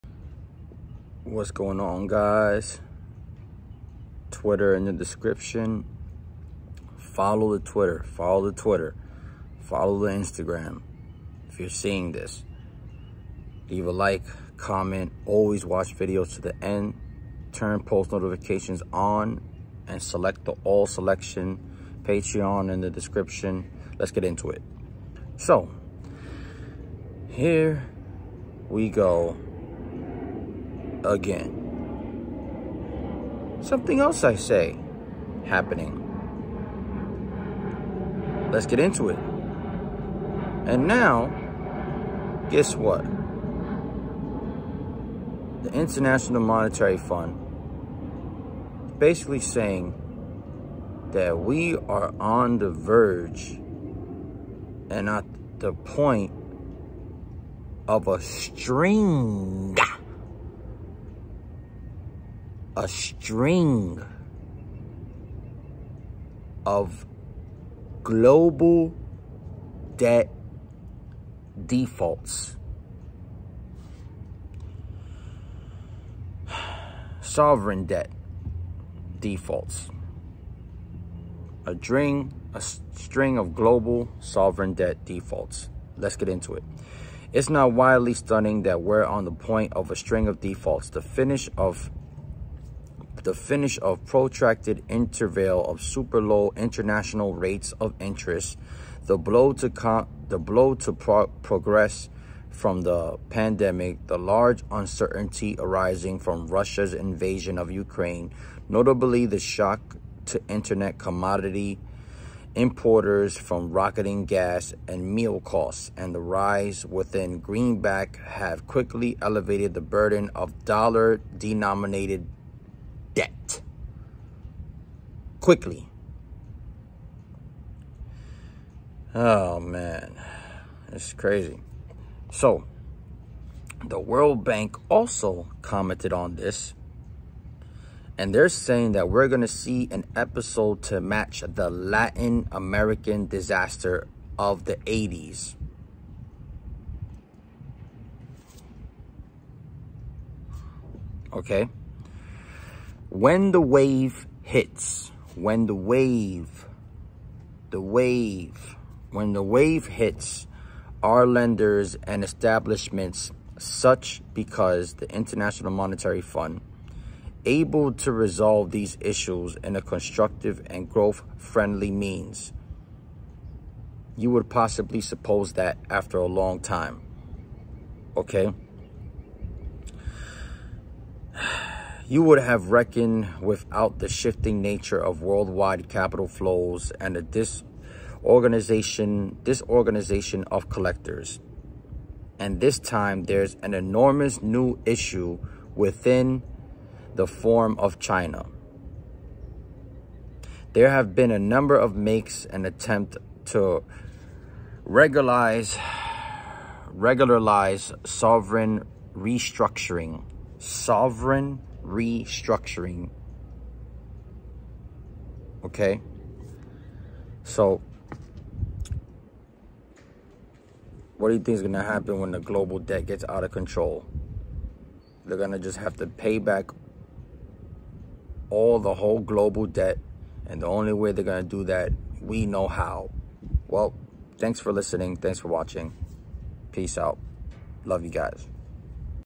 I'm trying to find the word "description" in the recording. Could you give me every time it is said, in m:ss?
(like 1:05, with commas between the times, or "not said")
0:04, 0:22.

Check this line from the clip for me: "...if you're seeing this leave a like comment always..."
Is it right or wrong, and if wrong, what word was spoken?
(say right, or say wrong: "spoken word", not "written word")
right.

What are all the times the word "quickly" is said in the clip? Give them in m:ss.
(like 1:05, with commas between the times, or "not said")
1:58, 2:05.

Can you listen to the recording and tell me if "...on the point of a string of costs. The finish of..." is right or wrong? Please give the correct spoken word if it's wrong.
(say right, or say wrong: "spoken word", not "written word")
wrong: "defaults", not "costs".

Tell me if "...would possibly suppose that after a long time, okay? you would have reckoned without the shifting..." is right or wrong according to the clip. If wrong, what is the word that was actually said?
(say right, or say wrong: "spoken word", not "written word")
right.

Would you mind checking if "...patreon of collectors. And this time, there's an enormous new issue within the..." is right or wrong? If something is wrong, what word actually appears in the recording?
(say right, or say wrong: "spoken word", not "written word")
wrong: "disorganization", not "patreon".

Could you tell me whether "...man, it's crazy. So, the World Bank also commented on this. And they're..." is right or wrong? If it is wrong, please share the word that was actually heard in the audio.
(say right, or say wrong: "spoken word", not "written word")
right.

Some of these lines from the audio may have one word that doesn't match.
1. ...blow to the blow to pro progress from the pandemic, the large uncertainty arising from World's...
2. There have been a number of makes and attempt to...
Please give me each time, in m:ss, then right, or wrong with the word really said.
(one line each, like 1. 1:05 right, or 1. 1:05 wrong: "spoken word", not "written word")
1. 1:39 wrong: "Russia", not "World"
2. 3:20 right.